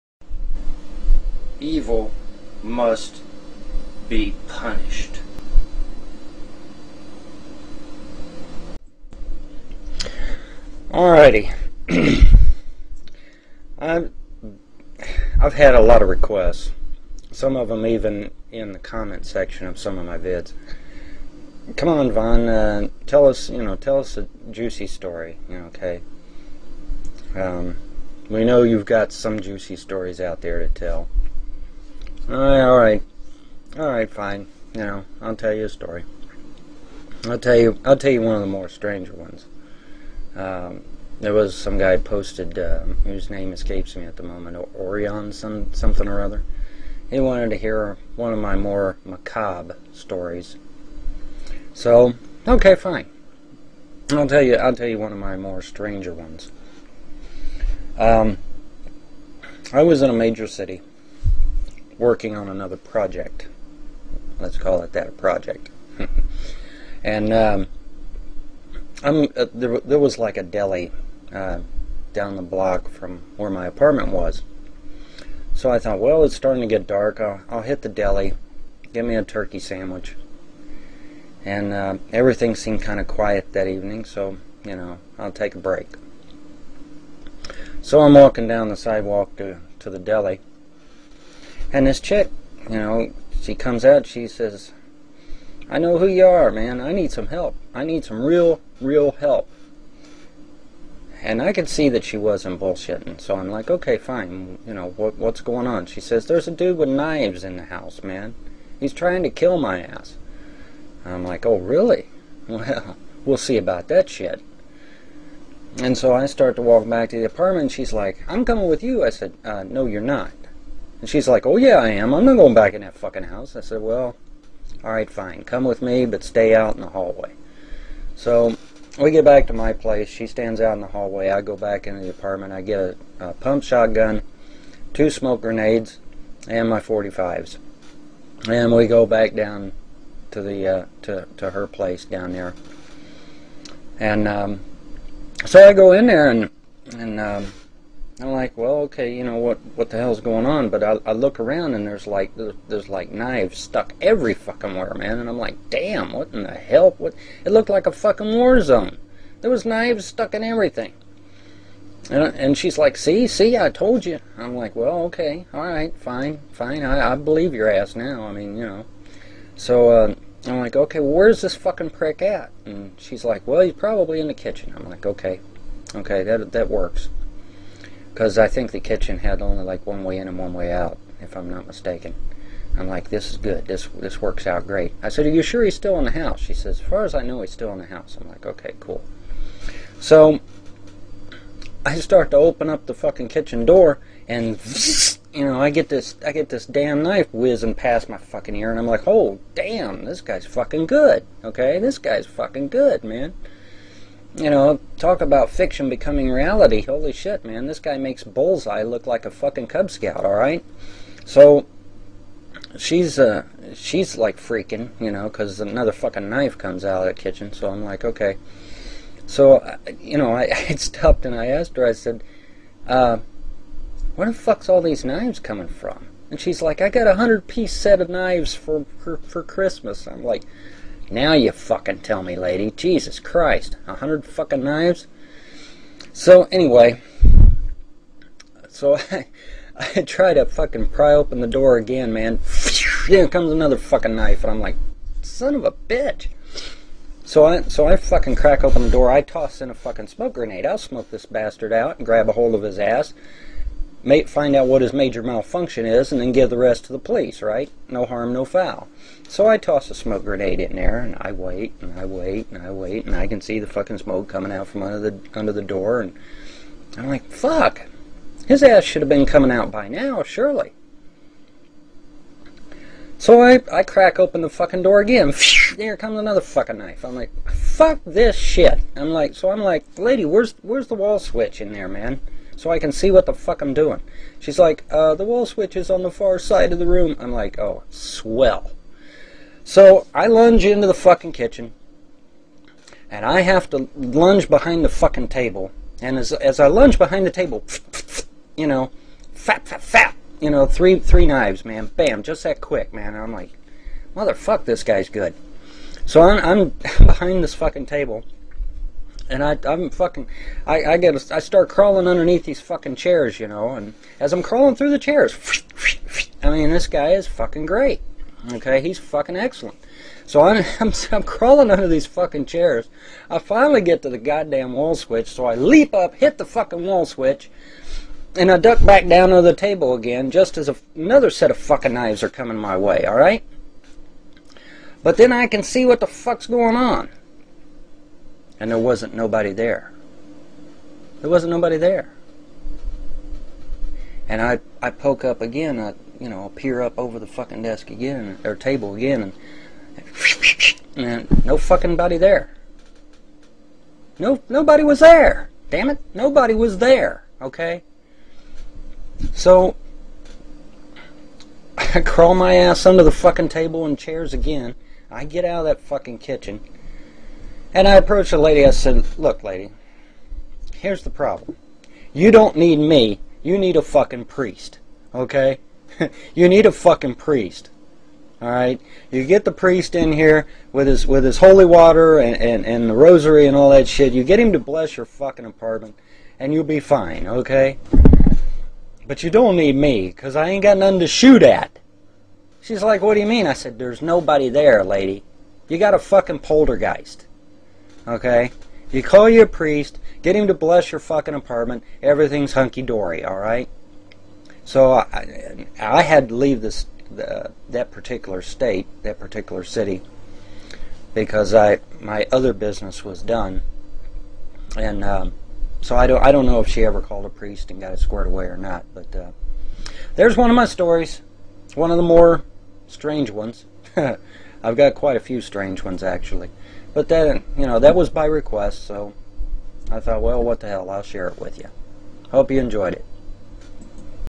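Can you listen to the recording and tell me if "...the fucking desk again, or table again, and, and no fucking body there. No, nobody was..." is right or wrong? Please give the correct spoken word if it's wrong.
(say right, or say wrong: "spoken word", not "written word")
right.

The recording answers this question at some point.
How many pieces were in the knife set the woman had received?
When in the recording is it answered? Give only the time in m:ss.
3:47.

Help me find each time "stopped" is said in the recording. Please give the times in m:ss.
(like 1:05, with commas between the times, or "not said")
3:40.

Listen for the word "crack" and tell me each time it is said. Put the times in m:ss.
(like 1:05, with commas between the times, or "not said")
4:08, 4:33.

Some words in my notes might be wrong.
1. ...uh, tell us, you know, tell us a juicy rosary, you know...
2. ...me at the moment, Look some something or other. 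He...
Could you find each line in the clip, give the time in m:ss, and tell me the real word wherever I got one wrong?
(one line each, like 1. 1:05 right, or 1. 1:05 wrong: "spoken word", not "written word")
1. 0:22 wrong: "story", not "rosary"
2. 0:43 wrong: "Orion", not "Look".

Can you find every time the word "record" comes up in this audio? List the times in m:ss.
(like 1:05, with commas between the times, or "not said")
not said.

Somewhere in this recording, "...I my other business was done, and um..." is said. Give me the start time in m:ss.
6:51.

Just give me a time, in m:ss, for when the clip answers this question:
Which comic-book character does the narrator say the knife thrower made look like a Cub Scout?
3:28.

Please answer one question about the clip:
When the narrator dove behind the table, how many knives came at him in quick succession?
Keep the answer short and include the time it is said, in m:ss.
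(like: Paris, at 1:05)
3, at 5:00.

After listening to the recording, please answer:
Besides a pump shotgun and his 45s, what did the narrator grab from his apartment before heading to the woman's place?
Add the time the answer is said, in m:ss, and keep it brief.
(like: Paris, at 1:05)
Two smoke grenades, at 2:14.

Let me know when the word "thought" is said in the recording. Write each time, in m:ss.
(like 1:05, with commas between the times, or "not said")
1:15, 7:09.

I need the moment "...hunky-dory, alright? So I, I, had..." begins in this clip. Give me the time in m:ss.
6:42.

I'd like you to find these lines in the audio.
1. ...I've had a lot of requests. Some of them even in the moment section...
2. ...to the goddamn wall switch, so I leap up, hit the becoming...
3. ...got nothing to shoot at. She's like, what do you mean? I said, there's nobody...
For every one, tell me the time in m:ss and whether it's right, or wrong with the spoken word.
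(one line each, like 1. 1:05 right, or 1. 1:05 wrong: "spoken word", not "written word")
1. 0:15 wrong: "comment", not "moment"
2. 5:24 wrong: "fucking", not "becoming"
3. 6:30 right.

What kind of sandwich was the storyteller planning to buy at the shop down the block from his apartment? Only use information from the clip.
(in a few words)
Turkey.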